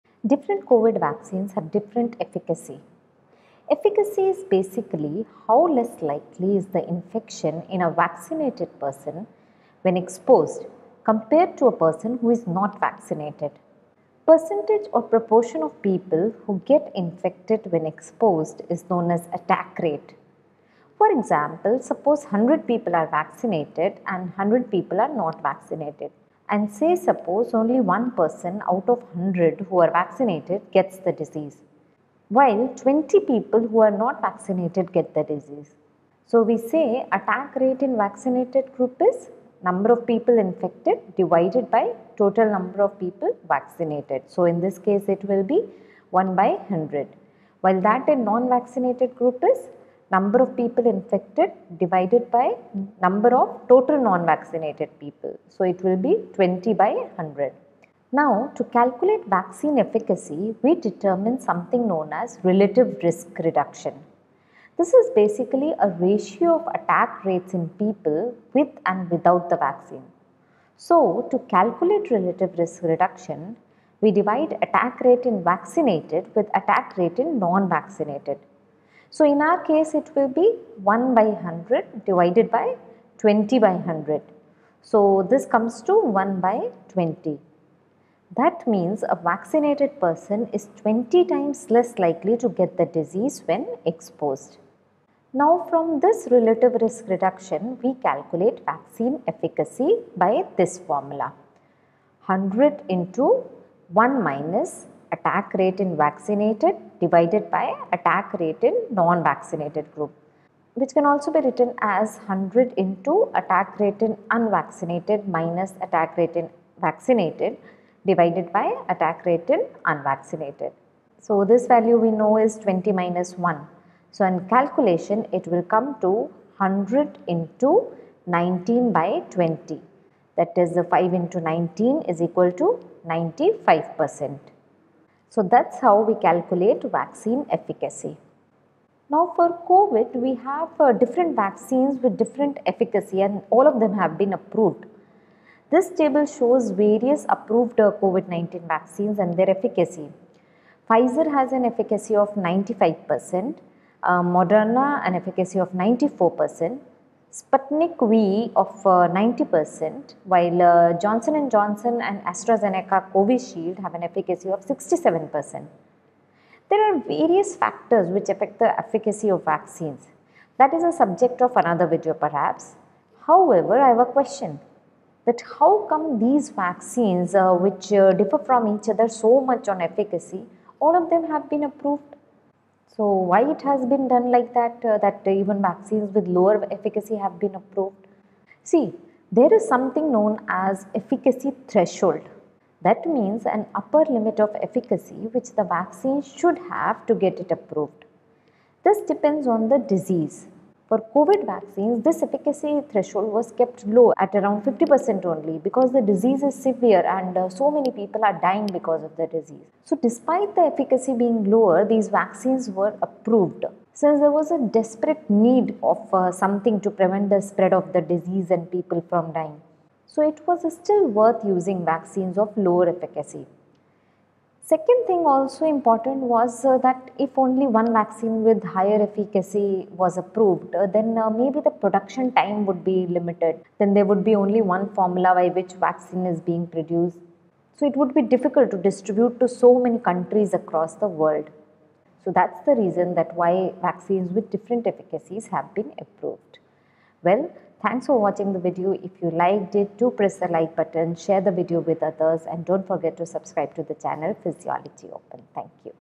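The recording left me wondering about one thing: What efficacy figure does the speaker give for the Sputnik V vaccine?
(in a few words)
90%.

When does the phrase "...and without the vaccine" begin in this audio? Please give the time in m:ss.
1:08.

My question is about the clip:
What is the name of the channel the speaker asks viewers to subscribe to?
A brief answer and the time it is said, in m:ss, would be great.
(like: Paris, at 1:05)
Physiology Open, at 4:14.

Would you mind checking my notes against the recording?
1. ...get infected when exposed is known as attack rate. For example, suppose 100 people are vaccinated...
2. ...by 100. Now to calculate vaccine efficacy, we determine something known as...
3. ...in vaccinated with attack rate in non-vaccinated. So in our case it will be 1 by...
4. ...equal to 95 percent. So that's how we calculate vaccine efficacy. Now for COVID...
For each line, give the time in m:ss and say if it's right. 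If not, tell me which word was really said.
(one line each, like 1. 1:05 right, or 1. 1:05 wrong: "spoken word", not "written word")
1. 0:16 right
2. 0:56 right
3. 1:15 right
4. 2:12 right.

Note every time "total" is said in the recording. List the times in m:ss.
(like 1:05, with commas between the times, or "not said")
0:42, 0:53.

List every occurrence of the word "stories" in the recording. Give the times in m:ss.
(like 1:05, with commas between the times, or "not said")
not said.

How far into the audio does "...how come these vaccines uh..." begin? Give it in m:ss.
2:55.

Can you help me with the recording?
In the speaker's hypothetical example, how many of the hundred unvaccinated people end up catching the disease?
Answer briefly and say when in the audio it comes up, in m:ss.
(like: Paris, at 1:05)
20, at 0:32.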